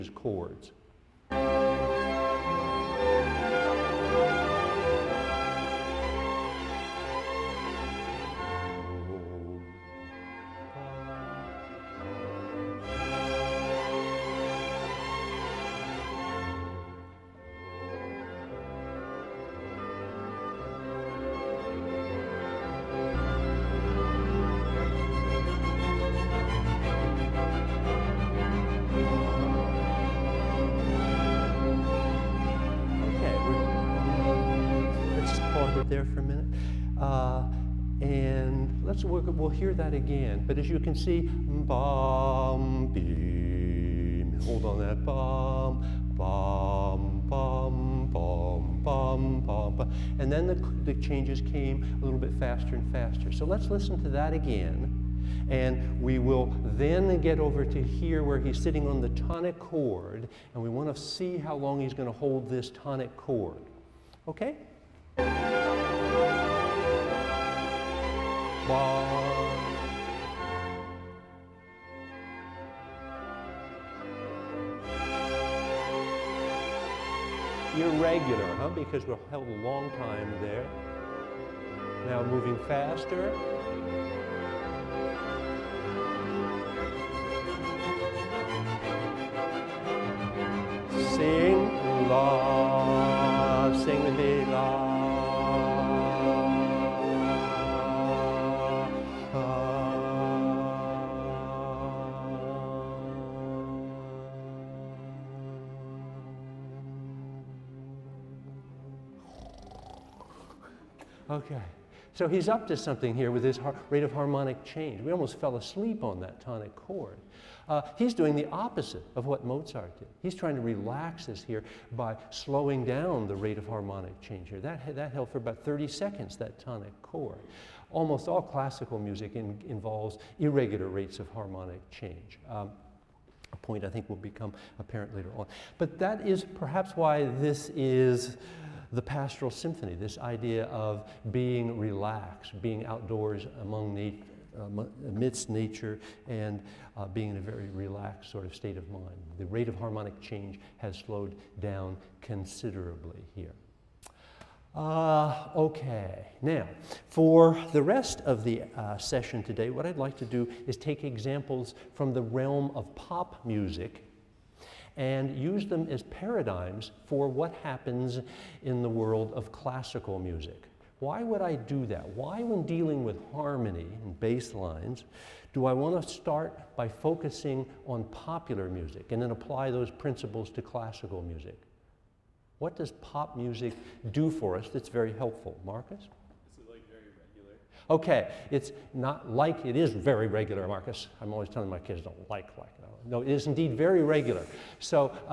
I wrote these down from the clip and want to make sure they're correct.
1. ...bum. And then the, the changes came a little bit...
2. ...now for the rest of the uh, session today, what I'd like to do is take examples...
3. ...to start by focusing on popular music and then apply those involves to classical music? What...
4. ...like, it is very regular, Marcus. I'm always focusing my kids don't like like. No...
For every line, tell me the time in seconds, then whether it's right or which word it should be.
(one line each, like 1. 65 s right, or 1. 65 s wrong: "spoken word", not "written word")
1. 49 s right
2. 156 s right
3. 176 s wrong: "principles", not "involves"
4. 189 s wrong: "telling", not "focusing".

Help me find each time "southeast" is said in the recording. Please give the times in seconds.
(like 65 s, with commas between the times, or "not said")
not said.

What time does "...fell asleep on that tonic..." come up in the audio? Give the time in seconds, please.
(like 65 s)
115 s.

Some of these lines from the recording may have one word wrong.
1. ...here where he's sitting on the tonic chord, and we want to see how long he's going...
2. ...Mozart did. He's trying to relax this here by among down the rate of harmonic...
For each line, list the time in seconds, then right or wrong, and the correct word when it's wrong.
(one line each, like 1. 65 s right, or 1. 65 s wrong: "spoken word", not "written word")
1. 57 s right
2. 119 s wrong: "slowing", not "among".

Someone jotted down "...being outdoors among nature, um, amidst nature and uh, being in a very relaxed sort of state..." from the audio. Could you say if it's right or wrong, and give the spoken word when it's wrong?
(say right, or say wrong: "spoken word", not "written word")
right.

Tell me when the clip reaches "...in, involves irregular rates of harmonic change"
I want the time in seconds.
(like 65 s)
129 s.